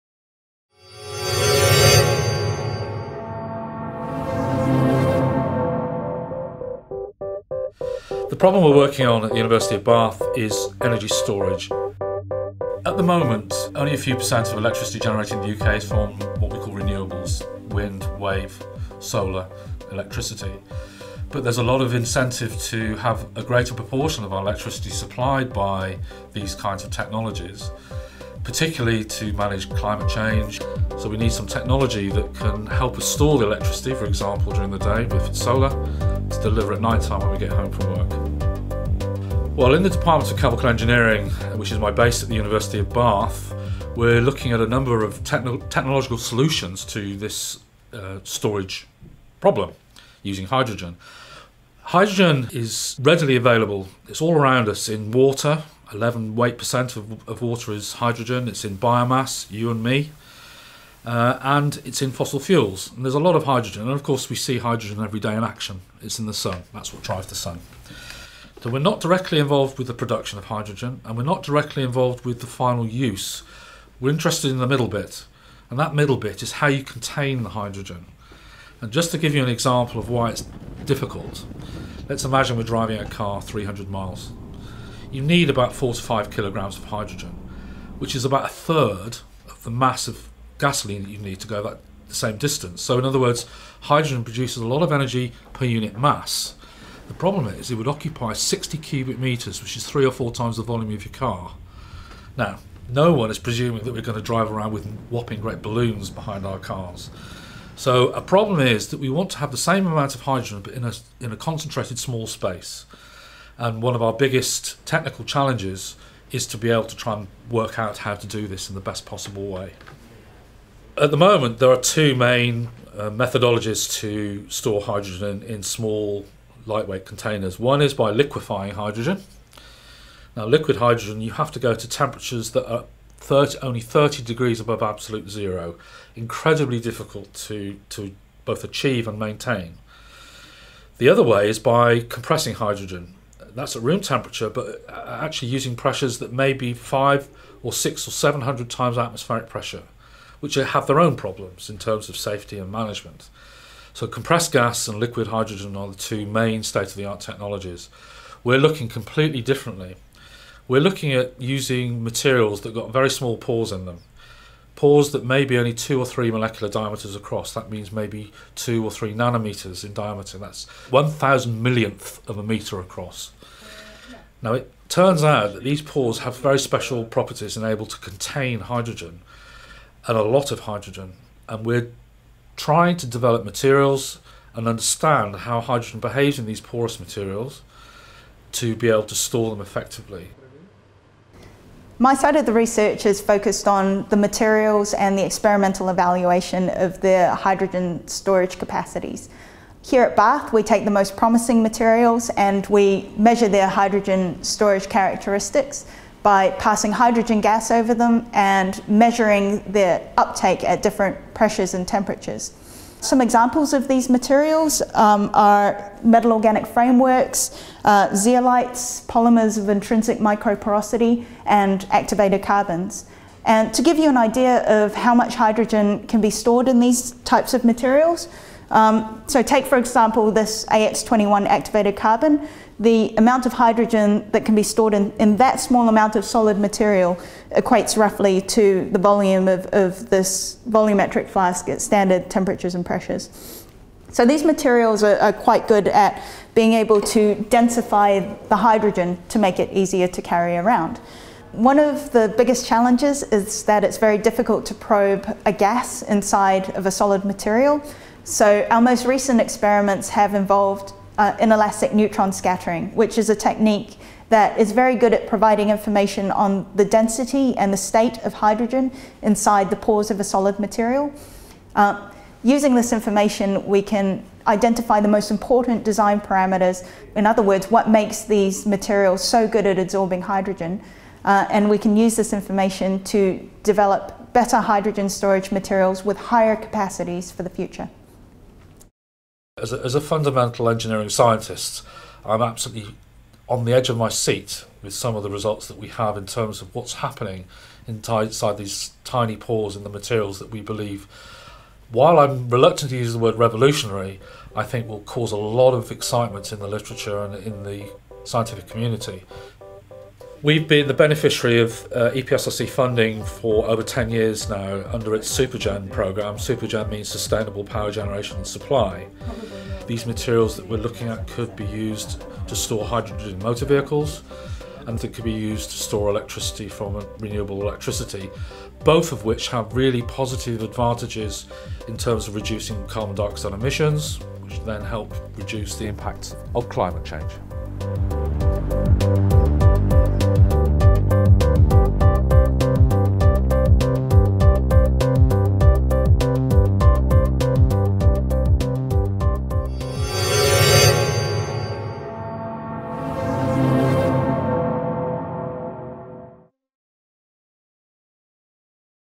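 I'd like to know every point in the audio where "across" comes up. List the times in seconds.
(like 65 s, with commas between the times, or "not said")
167 s, 172 s.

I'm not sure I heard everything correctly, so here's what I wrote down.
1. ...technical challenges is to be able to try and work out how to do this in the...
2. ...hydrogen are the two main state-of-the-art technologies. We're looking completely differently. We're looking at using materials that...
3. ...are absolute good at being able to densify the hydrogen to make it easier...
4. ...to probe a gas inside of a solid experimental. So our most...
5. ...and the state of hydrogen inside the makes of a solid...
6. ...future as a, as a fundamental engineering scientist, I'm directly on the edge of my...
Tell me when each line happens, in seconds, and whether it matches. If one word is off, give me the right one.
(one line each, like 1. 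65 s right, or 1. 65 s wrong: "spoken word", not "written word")
1. 114 s right
2. 155 s right
3. 245 s wrong: "quite", not "absolute"
4. 254 s wrong: "material", not "experimental"
5. 267 s wrong: "pores", not "makes"
6. 287 s wrong: "absolutely", not "directly".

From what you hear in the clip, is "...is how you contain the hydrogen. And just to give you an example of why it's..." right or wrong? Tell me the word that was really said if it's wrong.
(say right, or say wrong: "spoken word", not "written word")
right.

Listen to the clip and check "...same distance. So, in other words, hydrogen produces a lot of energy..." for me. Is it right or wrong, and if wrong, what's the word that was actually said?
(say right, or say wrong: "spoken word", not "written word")
right.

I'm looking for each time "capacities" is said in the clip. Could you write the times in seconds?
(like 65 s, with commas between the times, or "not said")
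198 s, 286 s.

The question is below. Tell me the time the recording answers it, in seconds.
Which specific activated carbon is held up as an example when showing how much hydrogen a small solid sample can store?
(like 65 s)
230 s.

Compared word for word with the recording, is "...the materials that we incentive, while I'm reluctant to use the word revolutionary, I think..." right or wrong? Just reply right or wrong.
wrong.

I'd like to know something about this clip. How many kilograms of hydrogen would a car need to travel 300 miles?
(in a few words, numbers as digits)
4 to 5 kilograms.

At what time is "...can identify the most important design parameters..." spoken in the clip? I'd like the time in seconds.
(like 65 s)
273 s.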